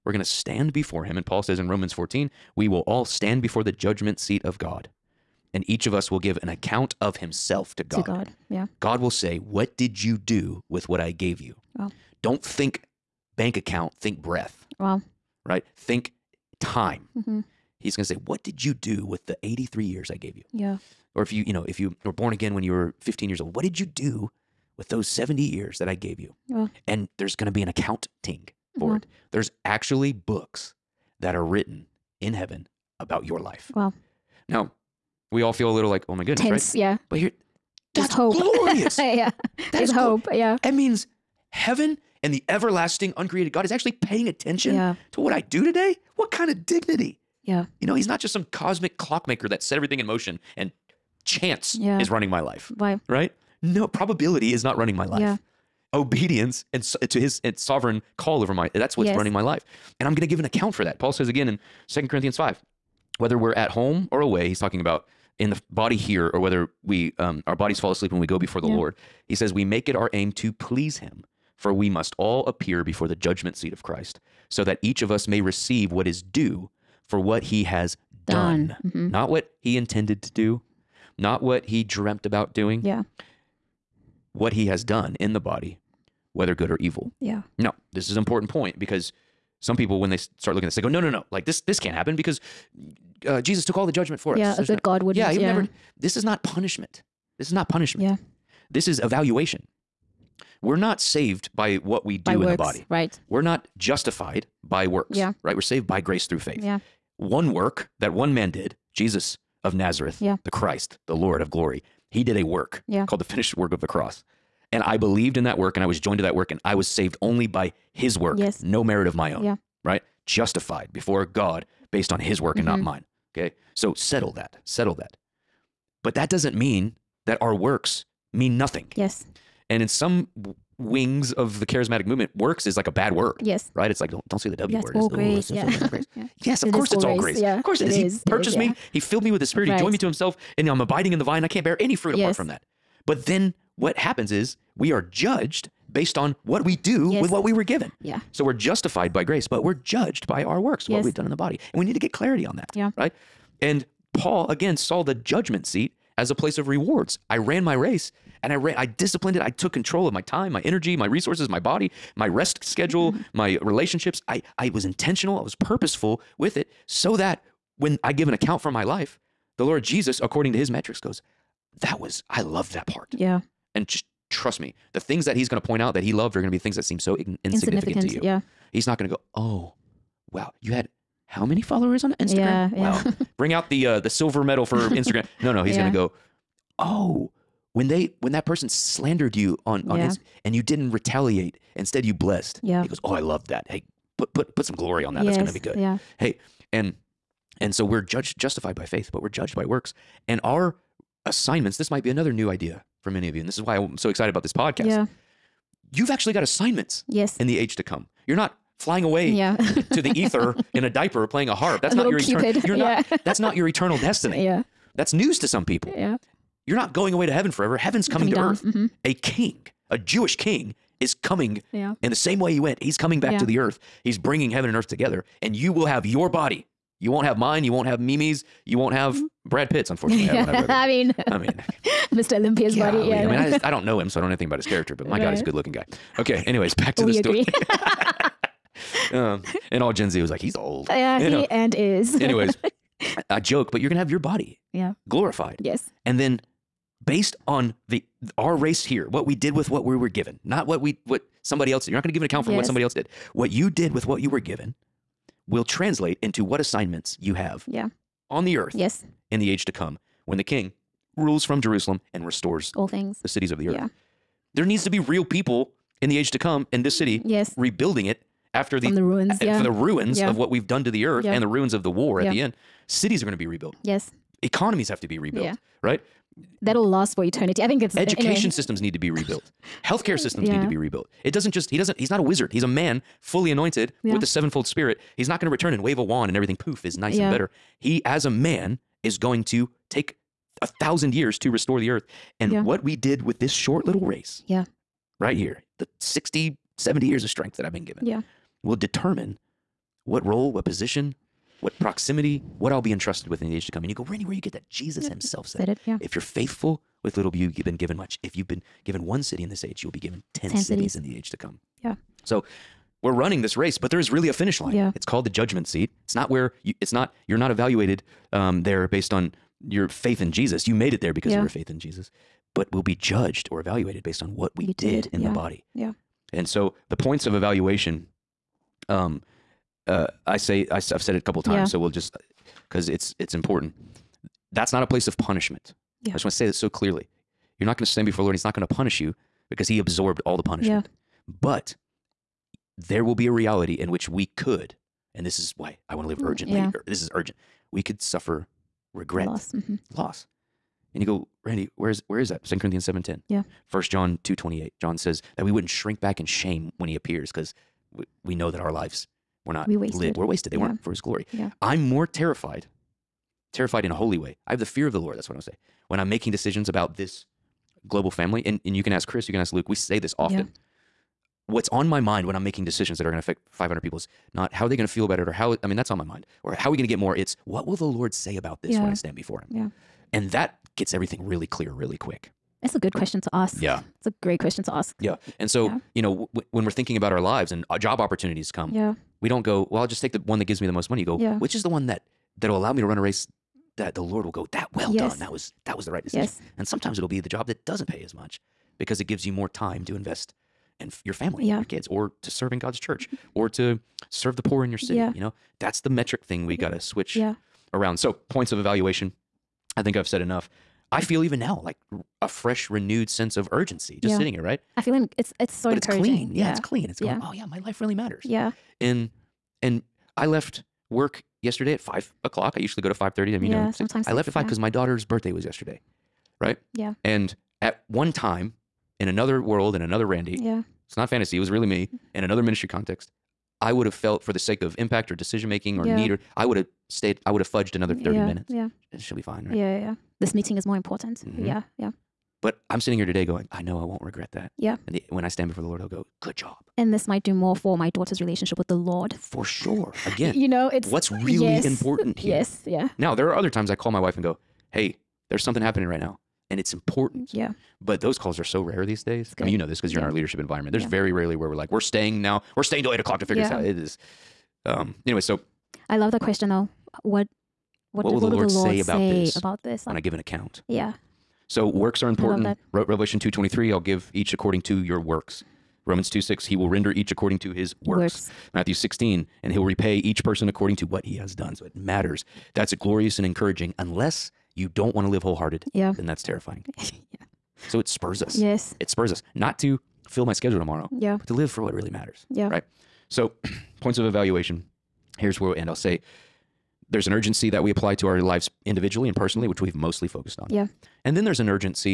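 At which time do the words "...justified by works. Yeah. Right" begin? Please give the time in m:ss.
1:43.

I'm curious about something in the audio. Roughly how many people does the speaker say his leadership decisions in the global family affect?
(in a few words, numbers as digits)
500.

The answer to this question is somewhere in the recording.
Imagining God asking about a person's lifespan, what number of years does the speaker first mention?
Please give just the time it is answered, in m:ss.
0:19.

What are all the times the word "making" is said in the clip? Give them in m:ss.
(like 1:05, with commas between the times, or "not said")
6:06, 6:12, 7:15.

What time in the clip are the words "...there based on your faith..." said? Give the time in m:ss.
5:18.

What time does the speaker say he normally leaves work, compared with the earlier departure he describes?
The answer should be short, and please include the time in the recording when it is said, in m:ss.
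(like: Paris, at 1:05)
5:30, at 7:02.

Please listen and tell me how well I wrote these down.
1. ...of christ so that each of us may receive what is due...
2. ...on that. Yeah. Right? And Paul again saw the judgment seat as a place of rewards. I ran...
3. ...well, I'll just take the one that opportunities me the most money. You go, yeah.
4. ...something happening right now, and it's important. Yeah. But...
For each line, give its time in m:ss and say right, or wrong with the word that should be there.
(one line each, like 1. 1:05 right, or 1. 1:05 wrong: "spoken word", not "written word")
1. 1:13 right
2. 2:32 right
3. 6:29 wrong: "gives", not "opportunities"
4. 7:35 right.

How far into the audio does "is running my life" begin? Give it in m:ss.
0:51.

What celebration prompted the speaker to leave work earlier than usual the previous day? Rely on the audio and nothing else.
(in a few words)
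Daughter's birthday.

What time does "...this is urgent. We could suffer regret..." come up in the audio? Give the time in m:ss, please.
5:46.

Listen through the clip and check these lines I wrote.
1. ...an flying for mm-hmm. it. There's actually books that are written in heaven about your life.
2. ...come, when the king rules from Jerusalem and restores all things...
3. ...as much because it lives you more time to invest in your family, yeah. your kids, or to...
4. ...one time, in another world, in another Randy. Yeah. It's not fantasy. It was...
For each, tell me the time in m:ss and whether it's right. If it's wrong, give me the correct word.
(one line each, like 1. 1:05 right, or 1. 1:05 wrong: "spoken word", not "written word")
1. 0:27 wrong: "accounting", not "flying"
2. 4:19 right
3. 6:38 wrong: "gives", not "lives"
4. 7:07 right.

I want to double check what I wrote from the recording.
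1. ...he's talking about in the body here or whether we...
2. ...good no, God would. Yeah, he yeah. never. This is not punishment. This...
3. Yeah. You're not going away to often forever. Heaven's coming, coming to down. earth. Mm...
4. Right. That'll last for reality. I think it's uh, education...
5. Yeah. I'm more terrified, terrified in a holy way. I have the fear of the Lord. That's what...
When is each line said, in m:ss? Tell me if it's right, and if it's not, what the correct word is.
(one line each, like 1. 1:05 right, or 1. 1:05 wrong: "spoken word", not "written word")
1. 1:04 right
2. 1:34 right
3. 3:35 wrong: "heaven", not "often"
4. 4:35 wrong: "eternity", not "reality"
5. 6:01 right.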